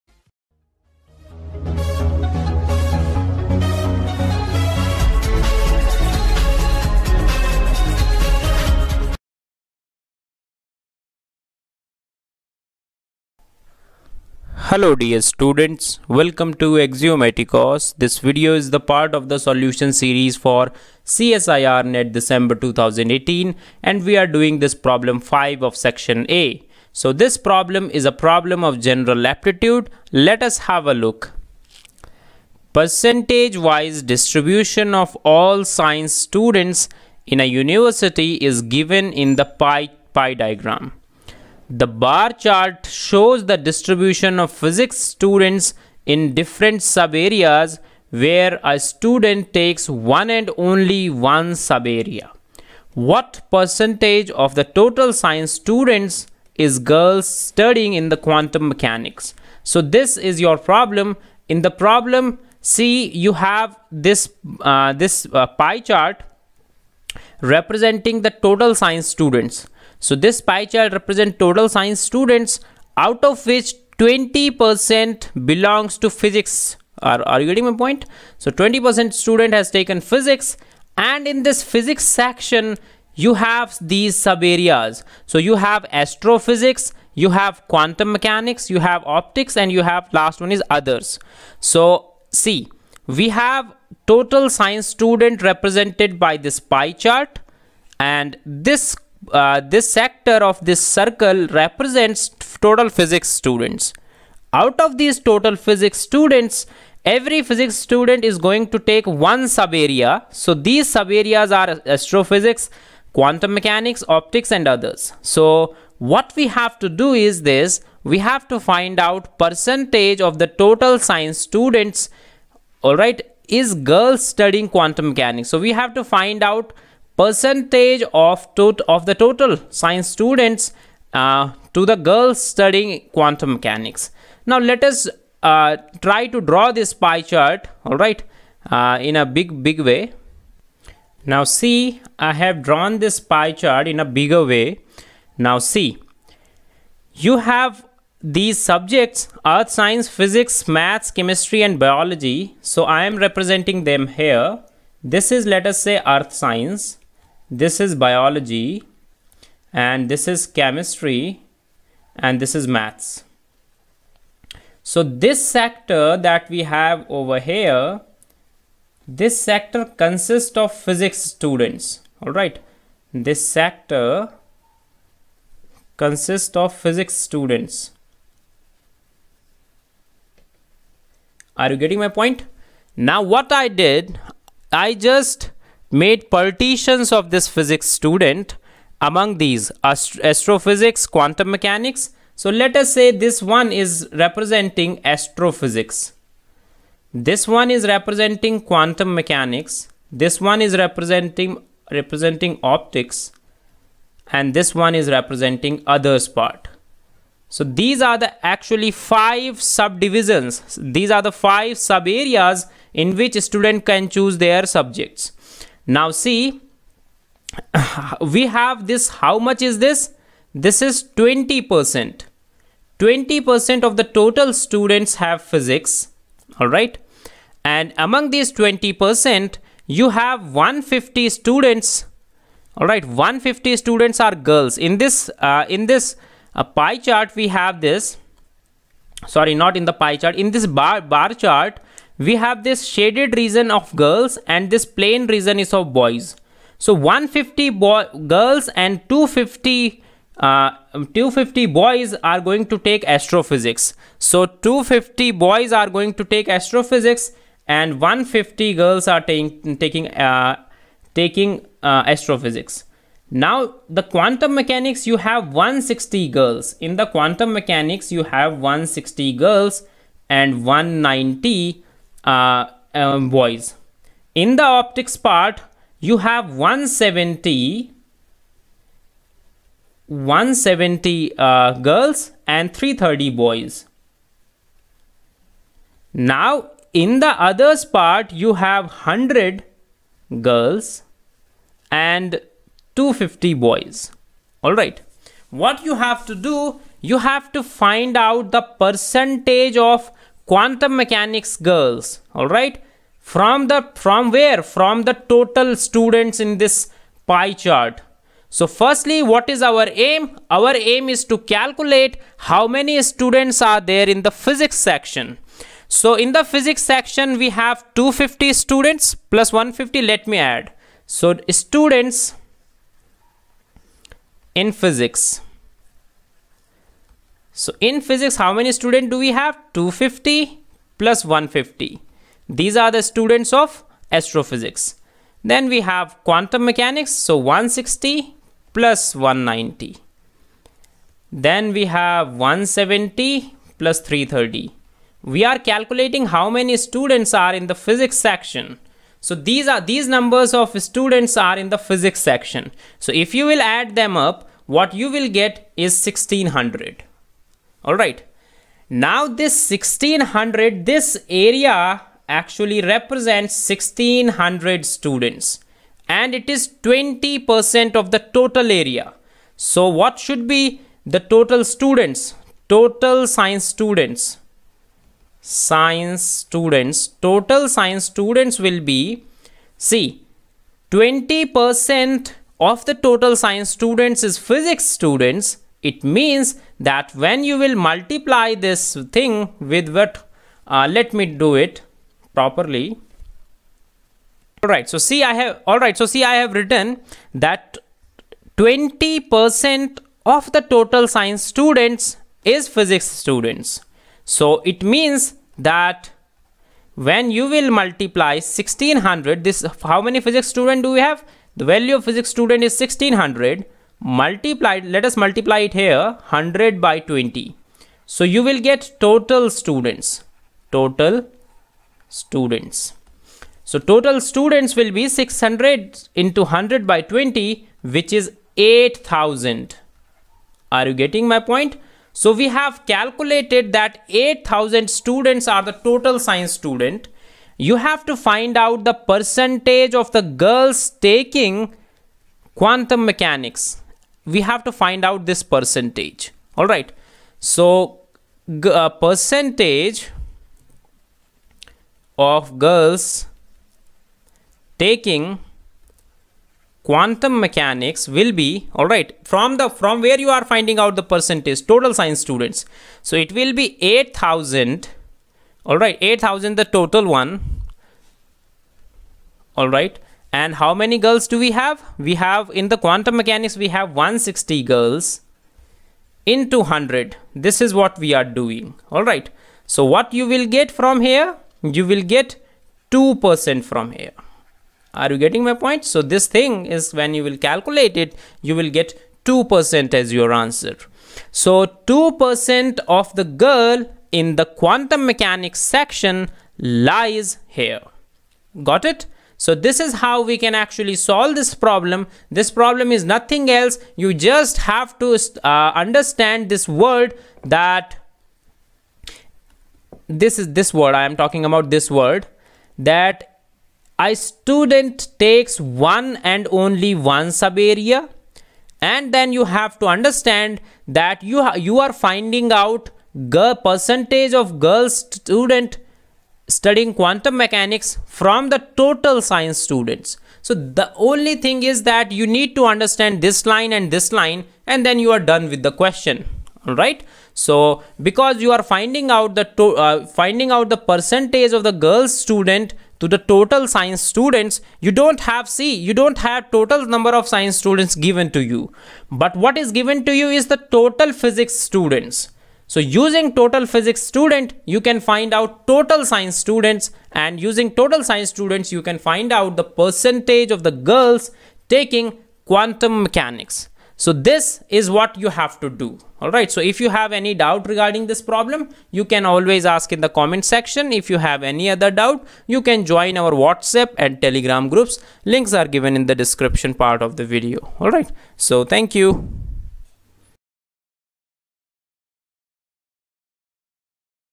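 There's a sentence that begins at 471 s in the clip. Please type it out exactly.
We have in the quantum mechanics, we have 160 girls into 100.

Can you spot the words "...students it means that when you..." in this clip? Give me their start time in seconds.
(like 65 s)
384 s.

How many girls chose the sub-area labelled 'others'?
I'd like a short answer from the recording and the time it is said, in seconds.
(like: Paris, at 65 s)
100, at 288 s.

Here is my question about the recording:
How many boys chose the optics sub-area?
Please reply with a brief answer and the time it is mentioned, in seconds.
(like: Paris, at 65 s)
330, at 282 s.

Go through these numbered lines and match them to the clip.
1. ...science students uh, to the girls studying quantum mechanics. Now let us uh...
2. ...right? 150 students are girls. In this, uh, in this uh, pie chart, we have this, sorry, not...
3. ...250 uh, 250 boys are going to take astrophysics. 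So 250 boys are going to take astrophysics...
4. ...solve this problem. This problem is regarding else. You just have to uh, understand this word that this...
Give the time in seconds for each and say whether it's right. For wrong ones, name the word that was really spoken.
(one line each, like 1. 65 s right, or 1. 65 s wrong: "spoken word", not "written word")
1. 129 s right
2. 232 s right
3. 249 s right
4. 500 s wrong: "nothing", not "regarding".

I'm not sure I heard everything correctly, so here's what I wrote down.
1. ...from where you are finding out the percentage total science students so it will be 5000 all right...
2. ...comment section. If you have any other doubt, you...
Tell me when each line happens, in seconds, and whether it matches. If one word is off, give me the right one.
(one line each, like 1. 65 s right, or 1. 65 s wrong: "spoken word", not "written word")
1. 459 s wrong: "8000", not "5000"
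2. 570 s right.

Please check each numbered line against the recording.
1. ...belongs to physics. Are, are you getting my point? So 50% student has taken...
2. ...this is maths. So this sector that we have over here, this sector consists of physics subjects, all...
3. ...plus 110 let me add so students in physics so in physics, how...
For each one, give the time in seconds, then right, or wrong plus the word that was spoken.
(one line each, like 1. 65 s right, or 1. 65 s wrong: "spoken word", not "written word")
1. 75 s wrong: "20", not "50"
2. 162 s wrong: "students", not "subjects"
3. 319 s wrong: "150", not "110".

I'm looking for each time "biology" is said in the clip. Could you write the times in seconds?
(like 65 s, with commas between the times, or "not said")
151 s, 157 s.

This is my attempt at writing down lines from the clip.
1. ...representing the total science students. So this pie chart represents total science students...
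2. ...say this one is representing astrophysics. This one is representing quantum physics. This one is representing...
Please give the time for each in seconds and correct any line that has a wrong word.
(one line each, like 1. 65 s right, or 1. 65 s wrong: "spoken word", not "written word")
1. 67 s right
2. 192 s wrong: "mechanics", not "physics".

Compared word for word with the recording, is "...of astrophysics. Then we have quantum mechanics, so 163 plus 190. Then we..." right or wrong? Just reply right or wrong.
wrong.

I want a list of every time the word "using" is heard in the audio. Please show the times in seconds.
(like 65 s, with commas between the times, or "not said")
552 s, 557 s.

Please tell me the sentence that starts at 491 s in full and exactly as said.
So 2% of the girl in the quantum mechanics section lies here.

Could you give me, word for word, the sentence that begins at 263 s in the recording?
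Now the quantum mechanics you have 160 girls.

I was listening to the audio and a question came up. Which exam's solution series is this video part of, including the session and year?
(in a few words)
CSIR NET December 2018.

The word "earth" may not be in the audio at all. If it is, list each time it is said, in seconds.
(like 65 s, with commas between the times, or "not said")
149 s, 156 s.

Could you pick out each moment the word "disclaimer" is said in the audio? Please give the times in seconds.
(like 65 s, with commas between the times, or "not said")
not said.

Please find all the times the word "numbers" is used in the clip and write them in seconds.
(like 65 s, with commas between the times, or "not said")
350 s, 546 s.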